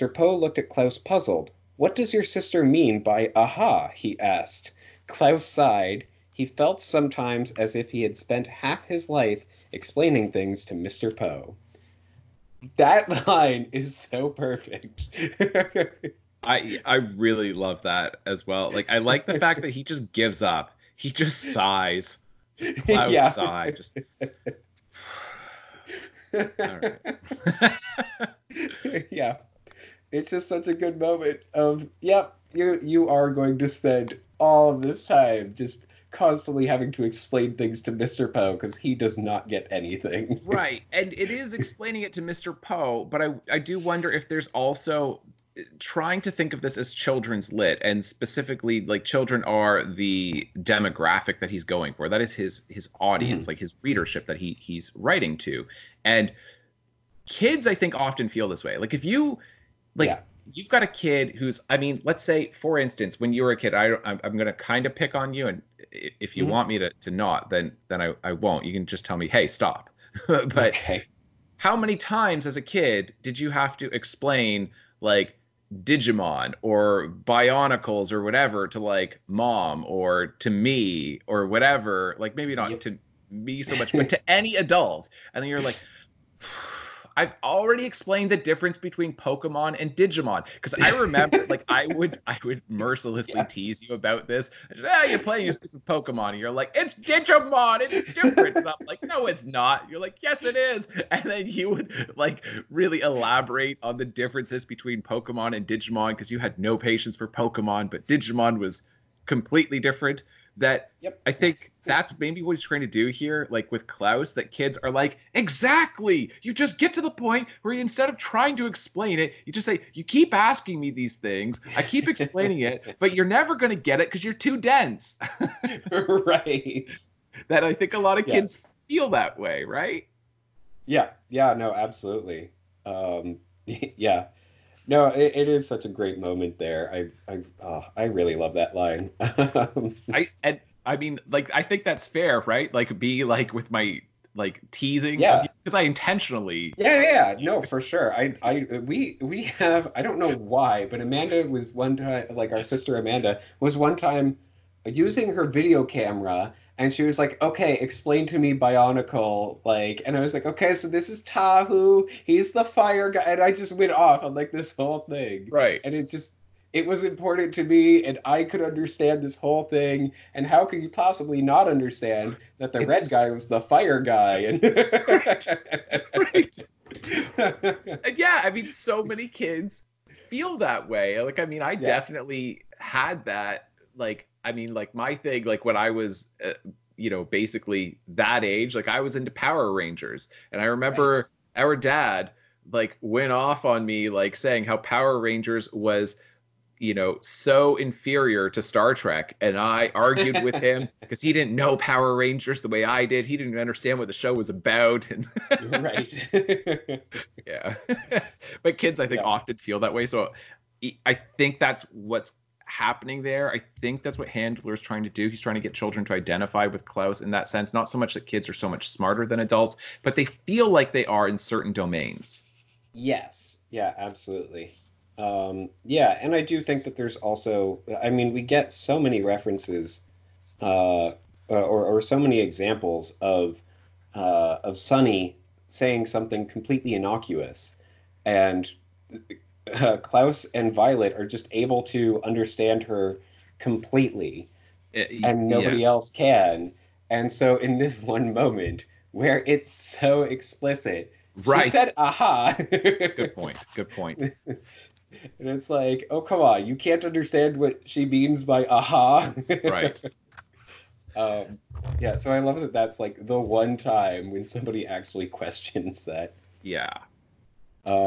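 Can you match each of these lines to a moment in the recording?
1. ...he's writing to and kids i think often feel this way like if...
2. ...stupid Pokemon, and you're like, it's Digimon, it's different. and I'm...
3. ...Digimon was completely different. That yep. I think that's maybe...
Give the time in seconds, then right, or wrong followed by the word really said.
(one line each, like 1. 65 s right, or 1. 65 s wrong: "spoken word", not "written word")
1. 54 s right
2. 95 s right
3. 108 s right.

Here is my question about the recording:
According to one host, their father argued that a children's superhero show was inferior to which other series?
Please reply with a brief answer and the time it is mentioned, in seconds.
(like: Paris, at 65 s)
Star Trek, at 198 s.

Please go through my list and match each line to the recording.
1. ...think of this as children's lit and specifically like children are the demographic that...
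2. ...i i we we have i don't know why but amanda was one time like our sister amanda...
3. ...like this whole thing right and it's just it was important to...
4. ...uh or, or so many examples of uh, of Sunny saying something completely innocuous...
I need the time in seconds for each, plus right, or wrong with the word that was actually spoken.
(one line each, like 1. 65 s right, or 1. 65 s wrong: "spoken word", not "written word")
1. 46 s right
2. 148 s right
3. 164 s right
4. 231 s right.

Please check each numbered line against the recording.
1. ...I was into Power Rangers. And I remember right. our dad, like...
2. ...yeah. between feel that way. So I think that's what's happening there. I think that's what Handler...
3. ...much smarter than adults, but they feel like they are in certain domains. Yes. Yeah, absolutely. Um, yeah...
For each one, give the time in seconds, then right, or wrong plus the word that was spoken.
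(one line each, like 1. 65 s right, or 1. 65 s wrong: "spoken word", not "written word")
1. 188 s right
2. 209 s wrong: "often", not "between"
3. 218 s right.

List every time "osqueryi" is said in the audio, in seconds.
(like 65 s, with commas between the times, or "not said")
not said.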